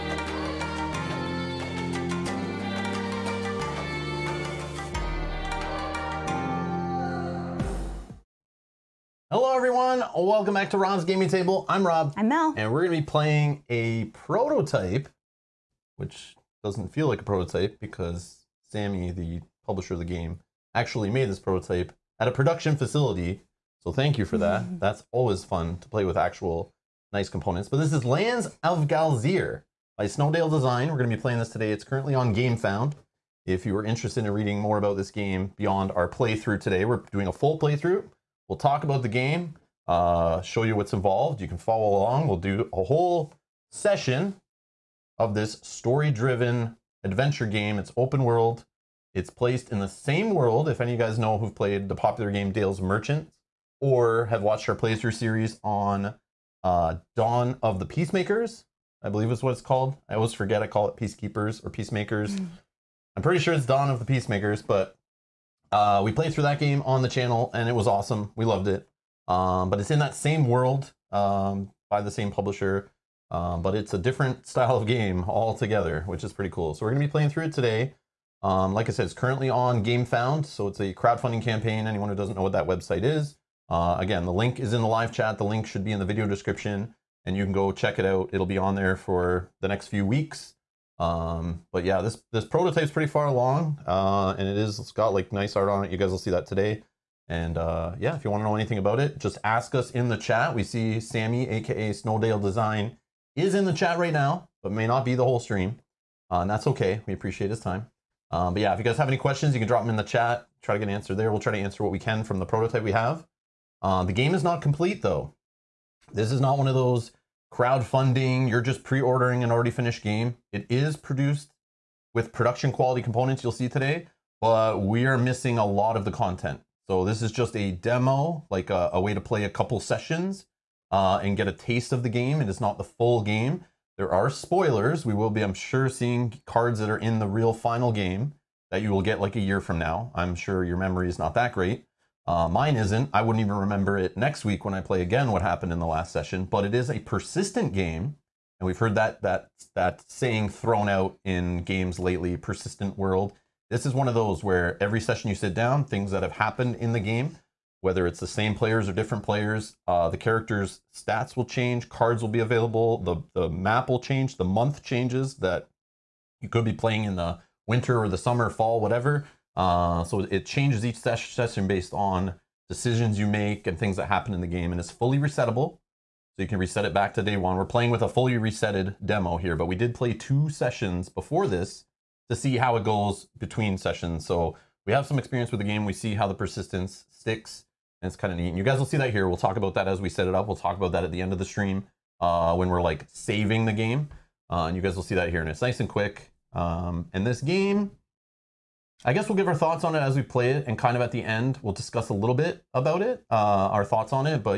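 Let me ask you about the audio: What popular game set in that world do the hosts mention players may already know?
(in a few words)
Dale's Merchant.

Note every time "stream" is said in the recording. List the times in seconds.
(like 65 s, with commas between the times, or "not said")
105 s, 191 s.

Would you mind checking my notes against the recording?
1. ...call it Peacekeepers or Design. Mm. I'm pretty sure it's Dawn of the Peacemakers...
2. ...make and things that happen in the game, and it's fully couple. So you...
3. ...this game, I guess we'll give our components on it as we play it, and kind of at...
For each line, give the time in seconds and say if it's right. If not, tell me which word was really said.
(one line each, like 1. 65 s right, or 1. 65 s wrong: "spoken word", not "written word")
1. 60 s wrong: "Peacemakers", not "Design"
2. 173 s wrong: "resettable", not "couple"
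3. 197 s wrong: "thoughts", not "components".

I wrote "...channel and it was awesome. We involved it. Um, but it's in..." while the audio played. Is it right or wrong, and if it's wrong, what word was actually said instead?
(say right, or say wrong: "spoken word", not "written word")
wrong: "loved", not "involved".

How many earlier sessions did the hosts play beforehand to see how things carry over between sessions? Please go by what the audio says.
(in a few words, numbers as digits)
2.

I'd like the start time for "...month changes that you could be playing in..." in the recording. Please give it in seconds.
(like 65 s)
164 s.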